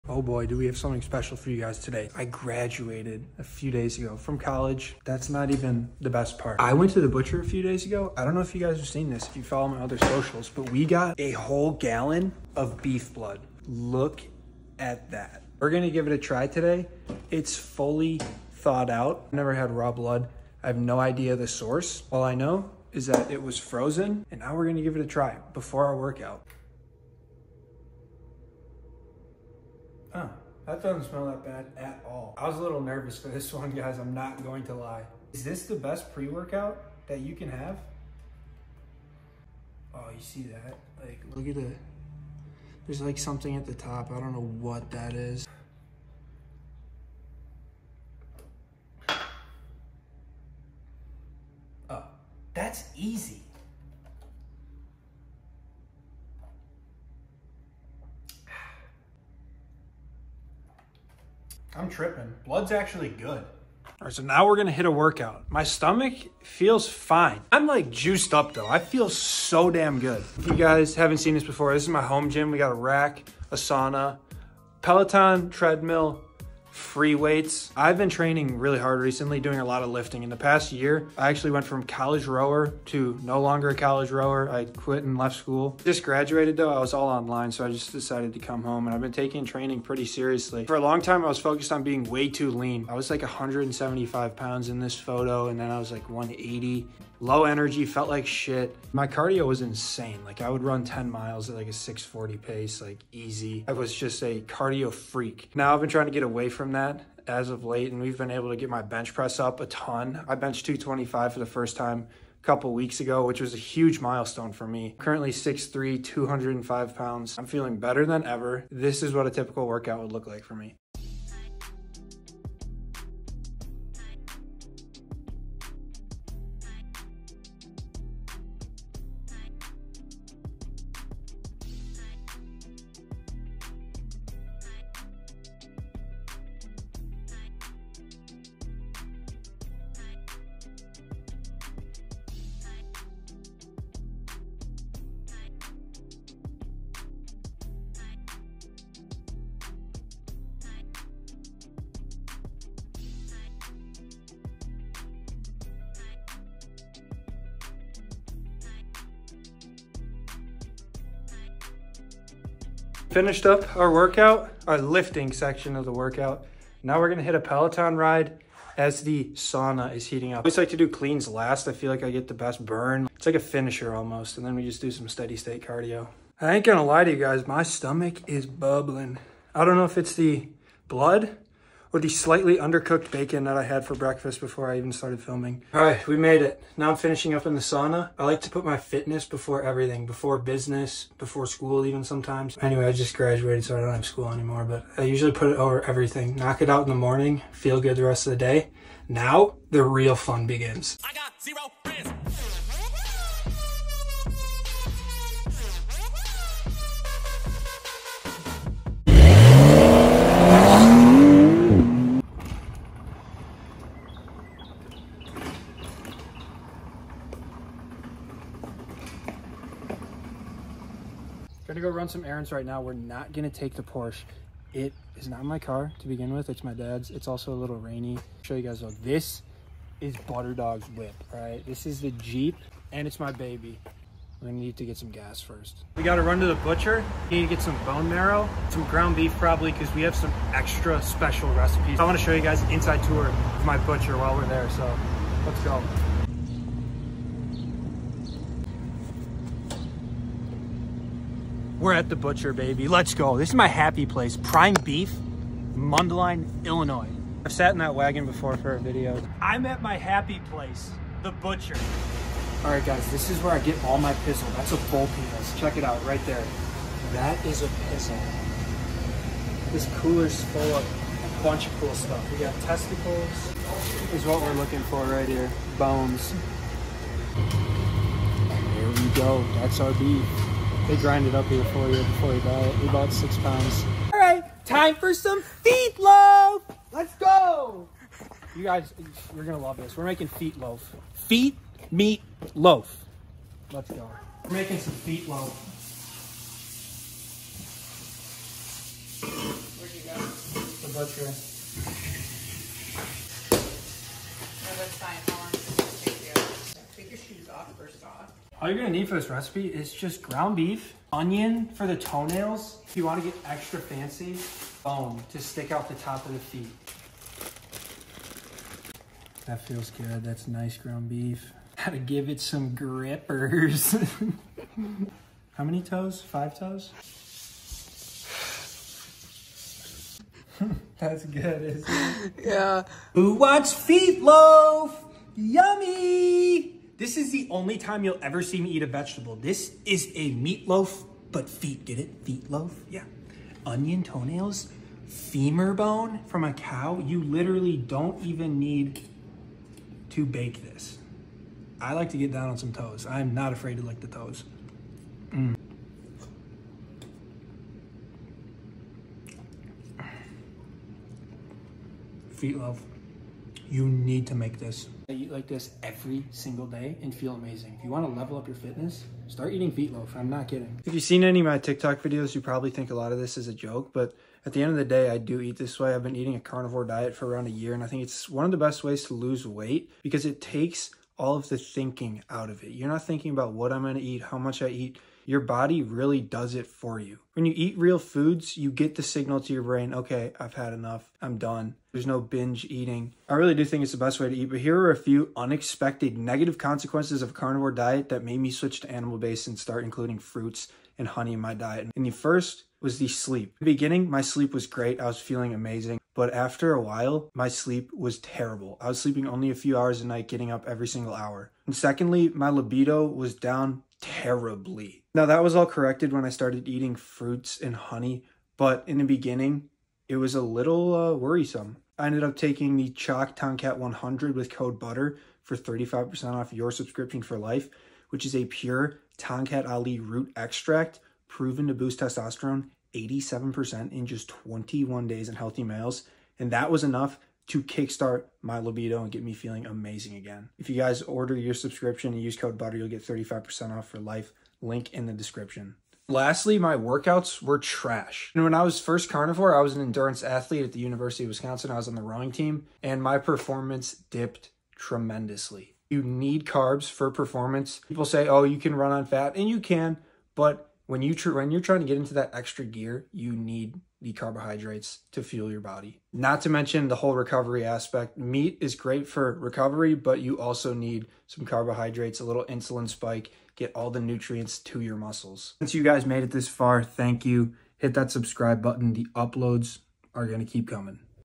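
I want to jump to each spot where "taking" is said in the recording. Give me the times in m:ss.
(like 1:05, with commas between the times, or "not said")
1:29, 7:02.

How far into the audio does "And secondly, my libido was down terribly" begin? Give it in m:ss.
6:51.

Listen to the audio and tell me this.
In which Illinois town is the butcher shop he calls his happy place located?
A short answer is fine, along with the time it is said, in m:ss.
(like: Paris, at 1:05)
Mundelein, at 4:15.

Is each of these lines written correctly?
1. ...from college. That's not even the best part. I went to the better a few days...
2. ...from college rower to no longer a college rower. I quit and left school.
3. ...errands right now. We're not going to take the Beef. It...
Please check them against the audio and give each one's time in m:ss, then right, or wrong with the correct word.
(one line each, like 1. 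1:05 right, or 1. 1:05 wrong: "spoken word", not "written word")
1. 0:04 wrong: "butcher", not "better"
2. 1:21 right
3. 3:42 wrong: "Porsche", not "Beef".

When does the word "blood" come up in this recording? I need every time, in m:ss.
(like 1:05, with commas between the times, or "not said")
0:13, 0:19, 1:02, 3:00.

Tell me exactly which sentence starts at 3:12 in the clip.
Anyway, I just graduated, so I don't have school anymore, but I usually put it over everything.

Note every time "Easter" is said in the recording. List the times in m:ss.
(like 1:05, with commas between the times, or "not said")
not said.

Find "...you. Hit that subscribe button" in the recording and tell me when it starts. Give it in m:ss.
7:57.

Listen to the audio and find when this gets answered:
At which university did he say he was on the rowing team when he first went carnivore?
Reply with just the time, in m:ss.
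7:30.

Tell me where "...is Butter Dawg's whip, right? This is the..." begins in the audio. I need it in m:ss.
3:49.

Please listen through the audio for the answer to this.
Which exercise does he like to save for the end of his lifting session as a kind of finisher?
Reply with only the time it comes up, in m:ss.
2:50.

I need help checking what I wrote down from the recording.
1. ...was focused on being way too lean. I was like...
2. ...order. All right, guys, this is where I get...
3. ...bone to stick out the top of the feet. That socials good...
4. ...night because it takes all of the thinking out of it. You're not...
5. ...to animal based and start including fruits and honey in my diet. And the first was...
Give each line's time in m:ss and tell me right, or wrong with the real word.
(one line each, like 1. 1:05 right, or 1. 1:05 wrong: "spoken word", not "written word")
1. 1:31 right
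2. 4:21 wrong: "butcher", not "order"
3. 5:14 wrong: "feels", not "socials"
4. 6:19 wrong: "weight", not "night"
5. 6:38 right.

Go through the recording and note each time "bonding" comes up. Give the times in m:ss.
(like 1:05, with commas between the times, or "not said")
not said.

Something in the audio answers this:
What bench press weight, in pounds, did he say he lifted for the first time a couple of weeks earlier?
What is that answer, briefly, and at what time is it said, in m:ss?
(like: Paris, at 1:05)
225, at 1:50.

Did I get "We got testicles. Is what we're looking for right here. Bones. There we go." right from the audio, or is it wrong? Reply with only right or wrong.
right.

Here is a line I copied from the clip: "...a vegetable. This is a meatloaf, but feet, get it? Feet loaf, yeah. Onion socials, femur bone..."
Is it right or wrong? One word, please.
wrong.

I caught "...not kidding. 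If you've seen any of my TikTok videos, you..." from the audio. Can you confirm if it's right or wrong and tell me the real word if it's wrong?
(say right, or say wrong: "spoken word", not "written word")
right.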